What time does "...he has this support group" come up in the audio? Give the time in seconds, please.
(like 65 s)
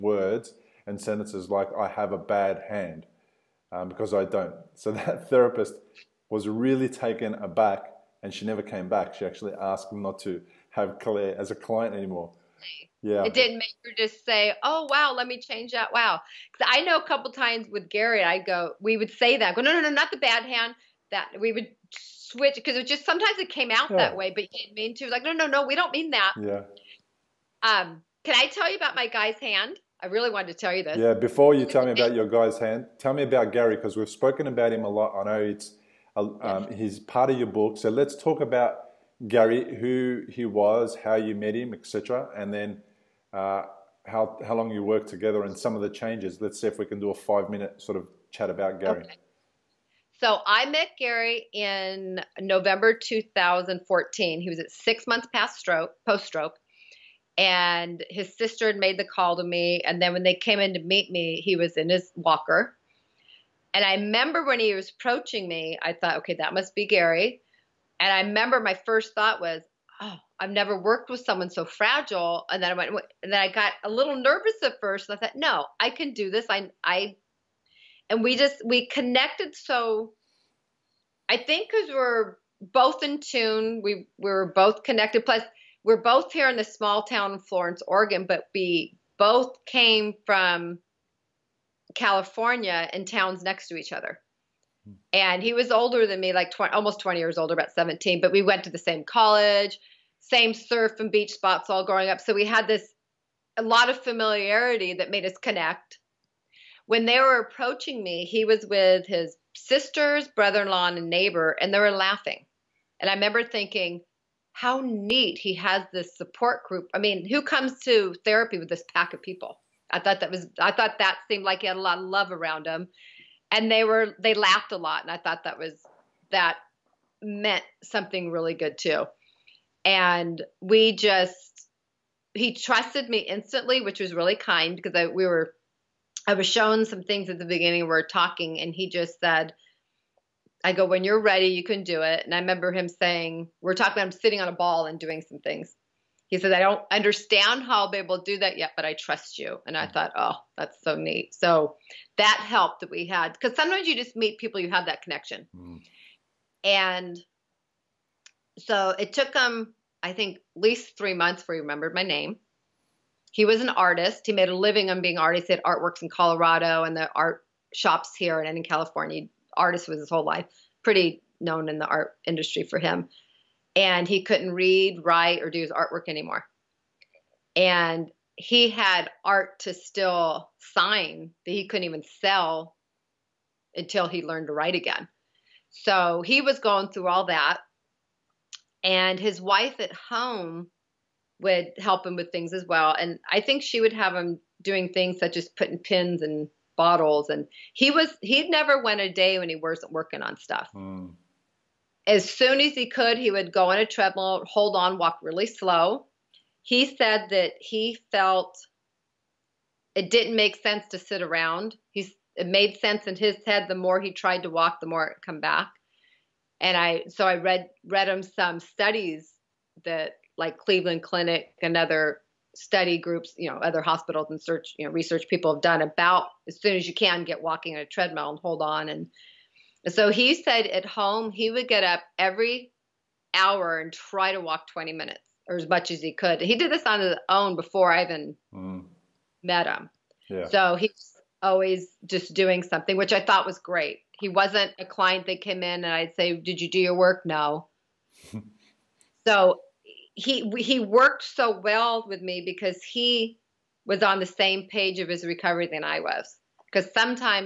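115 s.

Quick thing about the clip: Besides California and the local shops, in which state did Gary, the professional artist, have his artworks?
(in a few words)
Colorado.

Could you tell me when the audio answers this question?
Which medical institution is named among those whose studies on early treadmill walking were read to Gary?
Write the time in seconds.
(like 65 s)
220 s.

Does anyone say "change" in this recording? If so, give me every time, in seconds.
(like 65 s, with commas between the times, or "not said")
15 s, 45 s.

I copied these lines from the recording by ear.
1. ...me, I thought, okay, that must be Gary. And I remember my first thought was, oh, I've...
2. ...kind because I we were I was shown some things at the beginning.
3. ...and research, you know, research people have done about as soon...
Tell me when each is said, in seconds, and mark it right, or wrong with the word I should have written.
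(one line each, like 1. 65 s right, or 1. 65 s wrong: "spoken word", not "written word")
1. 65 s right
2. 134 s right
3. 224 s wrong: "search", not "research".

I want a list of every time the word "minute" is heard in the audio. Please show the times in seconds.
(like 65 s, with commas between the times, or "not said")
47 s, 234 s.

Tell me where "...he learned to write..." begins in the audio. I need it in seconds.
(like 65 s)
184 s.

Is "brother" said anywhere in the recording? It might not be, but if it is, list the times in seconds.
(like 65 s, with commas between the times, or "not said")
110 s.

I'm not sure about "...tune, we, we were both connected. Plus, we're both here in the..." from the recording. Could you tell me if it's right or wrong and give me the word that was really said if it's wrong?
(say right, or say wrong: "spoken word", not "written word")
right.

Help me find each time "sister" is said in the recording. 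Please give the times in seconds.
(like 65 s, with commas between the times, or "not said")
58 s, 109 s.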